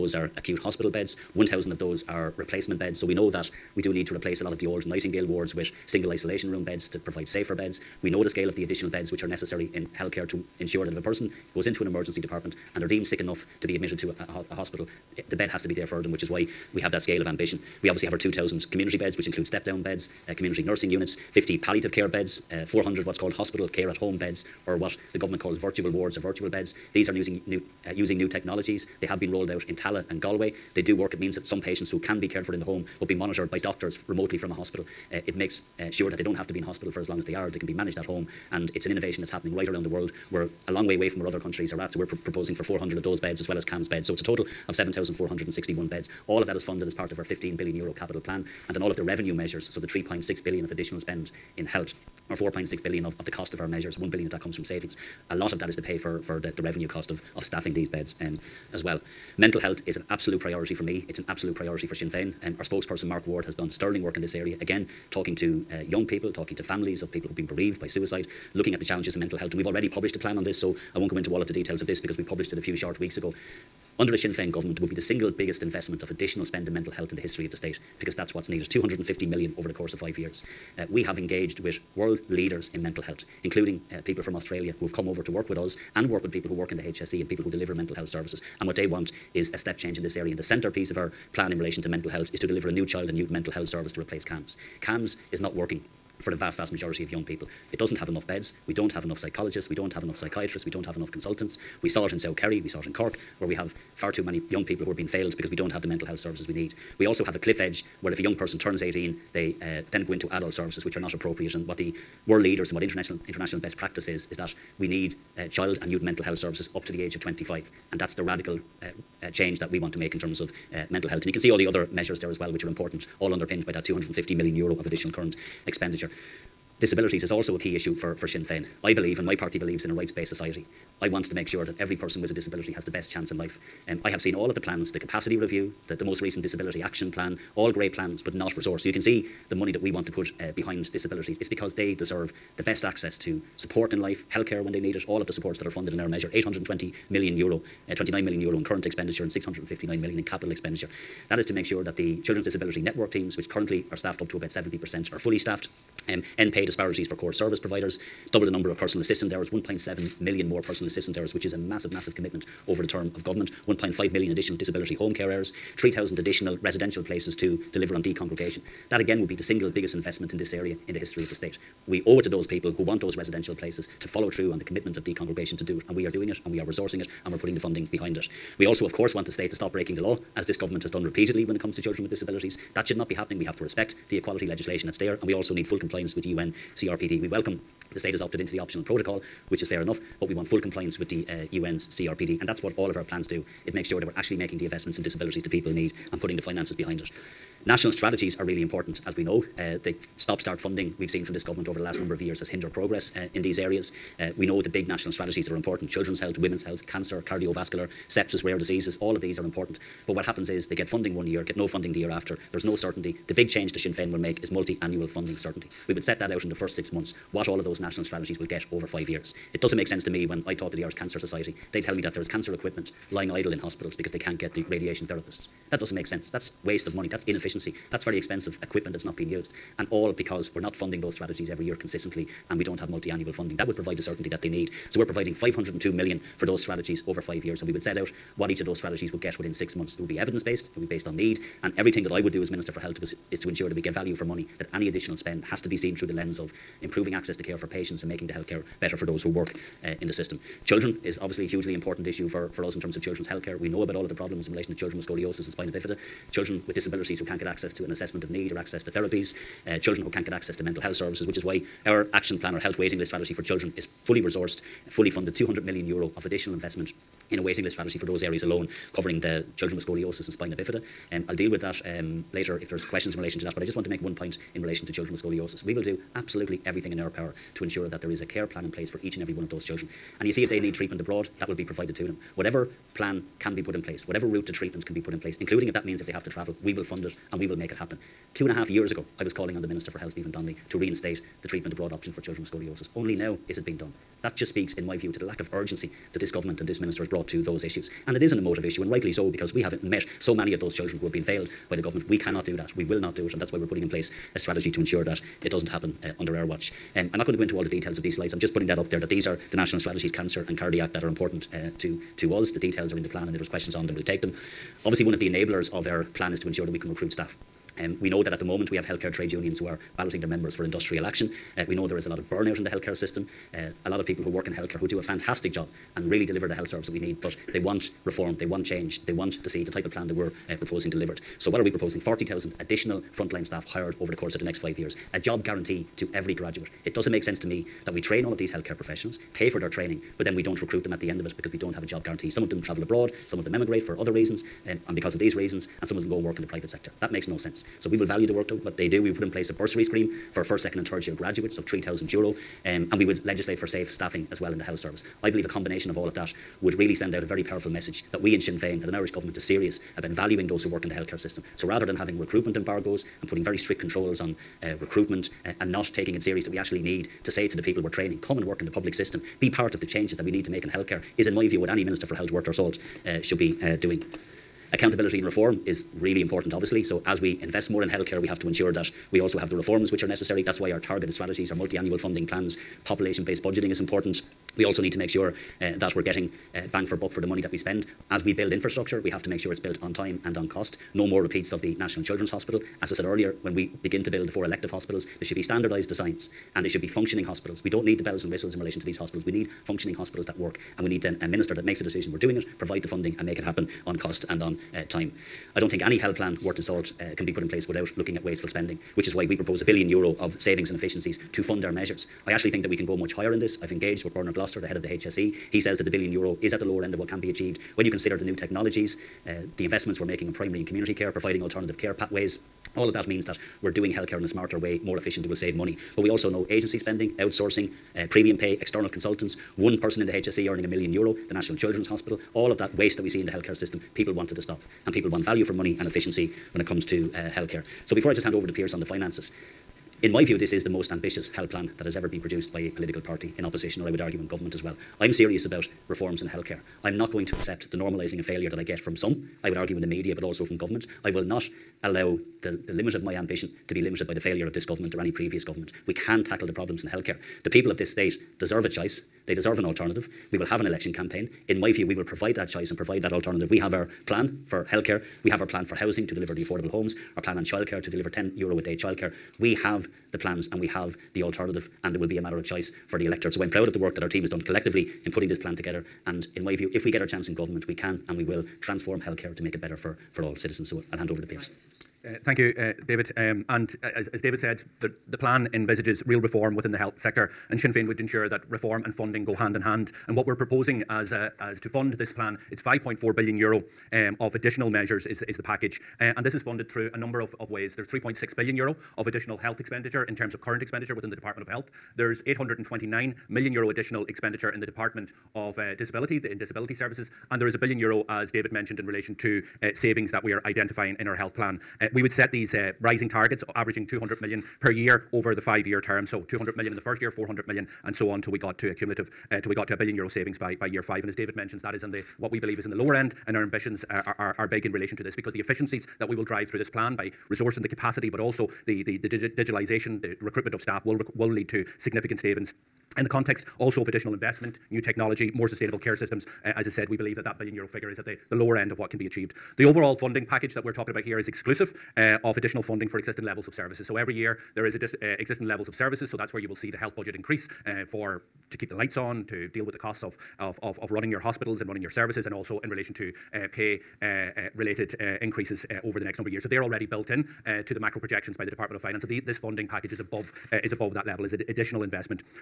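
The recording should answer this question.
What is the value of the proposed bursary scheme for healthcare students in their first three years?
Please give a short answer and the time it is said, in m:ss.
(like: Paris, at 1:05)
3,000 euro, at 5:51.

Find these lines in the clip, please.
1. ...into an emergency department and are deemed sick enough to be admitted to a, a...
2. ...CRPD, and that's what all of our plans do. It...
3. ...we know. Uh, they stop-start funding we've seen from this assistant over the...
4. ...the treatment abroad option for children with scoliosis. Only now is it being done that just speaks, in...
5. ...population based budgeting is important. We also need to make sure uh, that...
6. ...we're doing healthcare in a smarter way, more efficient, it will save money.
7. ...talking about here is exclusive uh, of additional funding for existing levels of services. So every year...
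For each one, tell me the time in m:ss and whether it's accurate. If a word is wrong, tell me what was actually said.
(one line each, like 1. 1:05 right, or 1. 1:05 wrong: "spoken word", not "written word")
1. 0:11 right
2. 3:11 right
3. 3:19 wrong: "government", not "assistant"
4. 4:51 right
5. 6:22 right
6. 7:03 right
7. 9:00 right.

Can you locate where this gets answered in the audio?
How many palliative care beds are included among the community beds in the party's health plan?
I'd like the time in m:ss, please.
0:21.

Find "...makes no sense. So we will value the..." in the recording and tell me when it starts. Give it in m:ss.
5:47.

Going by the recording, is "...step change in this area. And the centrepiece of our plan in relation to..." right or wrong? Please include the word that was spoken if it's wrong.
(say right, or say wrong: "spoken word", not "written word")
right.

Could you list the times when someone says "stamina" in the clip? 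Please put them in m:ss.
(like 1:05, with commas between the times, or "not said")
not said.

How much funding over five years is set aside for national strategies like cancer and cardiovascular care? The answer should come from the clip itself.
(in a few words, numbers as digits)
502 million.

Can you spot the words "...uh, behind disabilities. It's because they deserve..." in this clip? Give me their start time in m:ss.
2:20.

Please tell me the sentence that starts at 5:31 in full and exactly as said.
40,000 additional frontline staff hired over the course of the next five years, a job guarantee to every graduate.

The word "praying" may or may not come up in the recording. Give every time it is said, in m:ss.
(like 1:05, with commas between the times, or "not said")
not said.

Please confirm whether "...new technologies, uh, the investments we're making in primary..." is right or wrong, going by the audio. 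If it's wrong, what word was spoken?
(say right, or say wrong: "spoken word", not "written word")
right.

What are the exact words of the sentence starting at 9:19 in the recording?
So the, this funding package is above, is above that level, is an additional investment.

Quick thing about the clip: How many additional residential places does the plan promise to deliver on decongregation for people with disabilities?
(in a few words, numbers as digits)
3,000.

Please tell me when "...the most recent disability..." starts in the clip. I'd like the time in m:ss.
2:15.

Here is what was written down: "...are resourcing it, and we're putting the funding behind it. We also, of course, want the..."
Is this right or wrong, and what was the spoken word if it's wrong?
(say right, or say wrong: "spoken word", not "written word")
right.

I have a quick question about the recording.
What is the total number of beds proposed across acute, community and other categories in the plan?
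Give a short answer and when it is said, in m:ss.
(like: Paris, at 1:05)
7,461, at 0:44.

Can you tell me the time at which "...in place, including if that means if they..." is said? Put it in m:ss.
4:45.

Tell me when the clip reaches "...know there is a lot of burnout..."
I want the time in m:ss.
5:21.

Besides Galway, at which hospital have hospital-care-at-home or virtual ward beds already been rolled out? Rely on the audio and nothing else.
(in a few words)
Tallaght.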